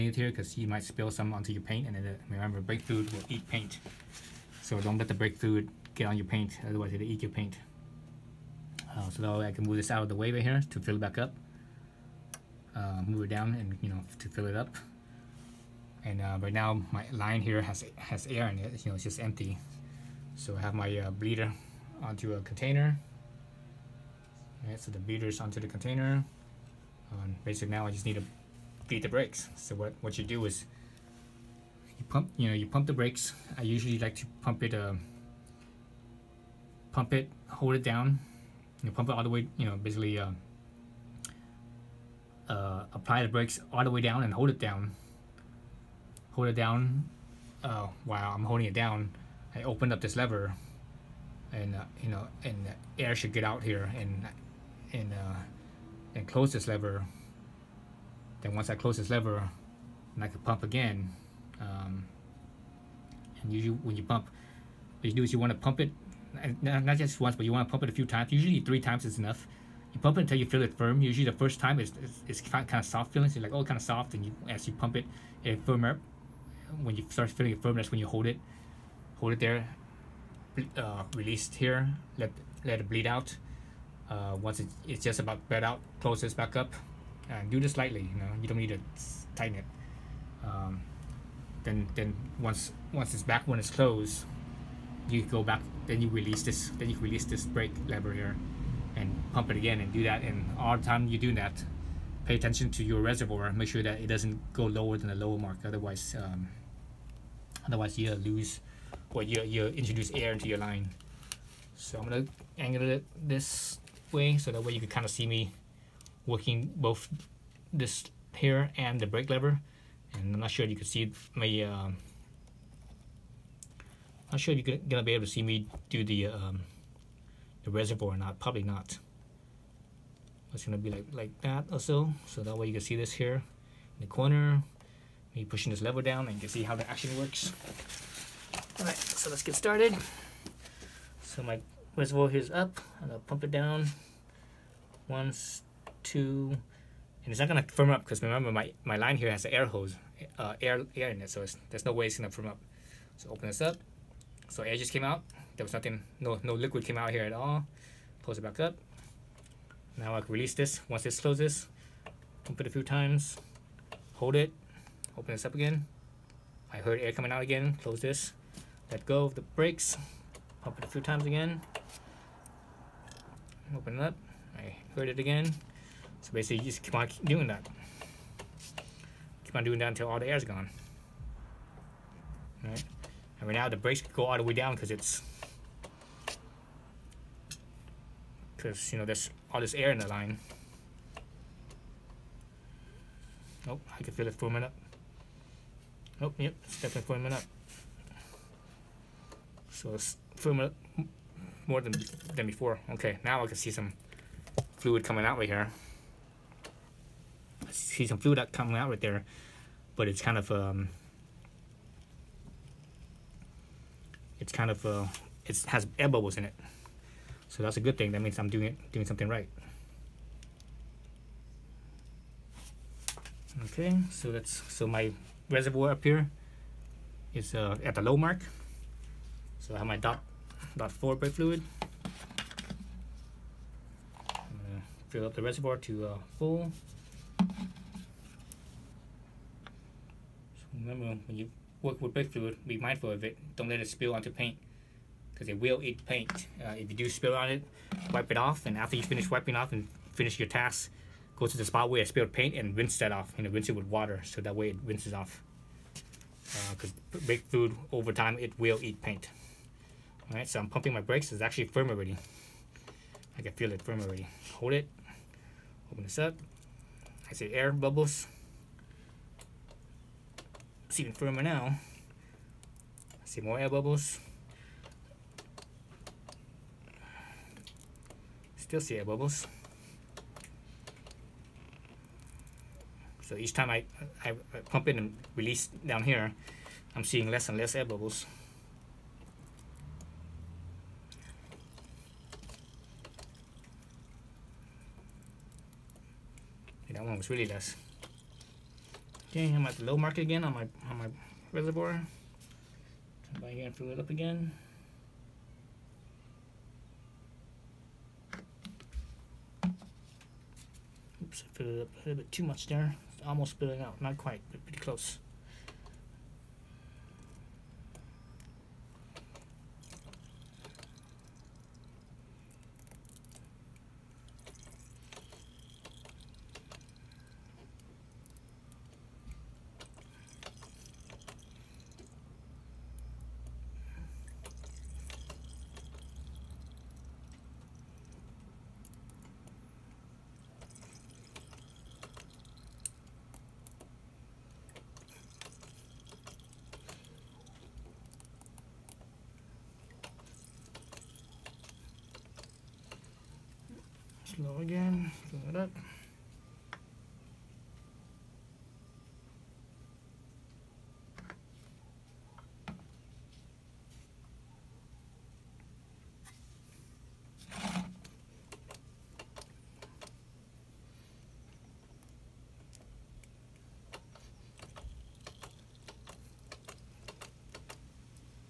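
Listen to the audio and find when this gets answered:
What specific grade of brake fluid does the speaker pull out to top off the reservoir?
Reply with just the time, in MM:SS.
03:49.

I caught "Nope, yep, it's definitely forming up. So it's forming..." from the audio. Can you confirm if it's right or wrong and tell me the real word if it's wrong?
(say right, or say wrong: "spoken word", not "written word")
right.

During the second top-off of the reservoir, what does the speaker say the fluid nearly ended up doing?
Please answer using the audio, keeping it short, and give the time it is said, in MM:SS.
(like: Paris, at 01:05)
spilling out, at 05:13.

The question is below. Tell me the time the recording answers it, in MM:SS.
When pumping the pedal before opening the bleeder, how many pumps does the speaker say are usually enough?
01:08.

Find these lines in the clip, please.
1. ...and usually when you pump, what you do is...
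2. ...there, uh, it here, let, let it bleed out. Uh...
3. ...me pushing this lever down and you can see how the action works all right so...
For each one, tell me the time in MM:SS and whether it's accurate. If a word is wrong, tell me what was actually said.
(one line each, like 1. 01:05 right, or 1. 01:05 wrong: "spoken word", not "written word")
1. 01:03 right
2. 01:19 right
3. 02:15 right.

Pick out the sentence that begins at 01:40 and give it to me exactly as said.
And all the time you do that, pay attention to your reservoir.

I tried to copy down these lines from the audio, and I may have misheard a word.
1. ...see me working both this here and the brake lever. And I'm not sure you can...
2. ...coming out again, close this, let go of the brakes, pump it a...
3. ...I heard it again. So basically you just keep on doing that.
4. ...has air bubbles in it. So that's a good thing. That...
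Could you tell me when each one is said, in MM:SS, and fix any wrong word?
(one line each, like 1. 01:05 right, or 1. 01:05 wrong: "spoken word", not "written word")
1. 01:55 right
2. 02:47 right
3. 02:54 right
4. 03:35 right.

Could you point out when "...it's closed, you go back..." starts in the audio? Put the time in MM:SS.
01:33.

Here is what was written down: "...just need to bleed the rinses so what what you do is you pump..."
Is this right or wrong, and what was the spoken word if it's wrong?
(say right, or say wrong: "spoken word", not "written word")
wrong: "brakes", not "rinses".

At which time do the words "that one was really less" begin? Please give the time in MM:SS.
04:56.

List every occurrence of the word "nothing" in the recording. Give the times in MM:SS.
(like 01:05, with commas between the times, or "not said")
02:35.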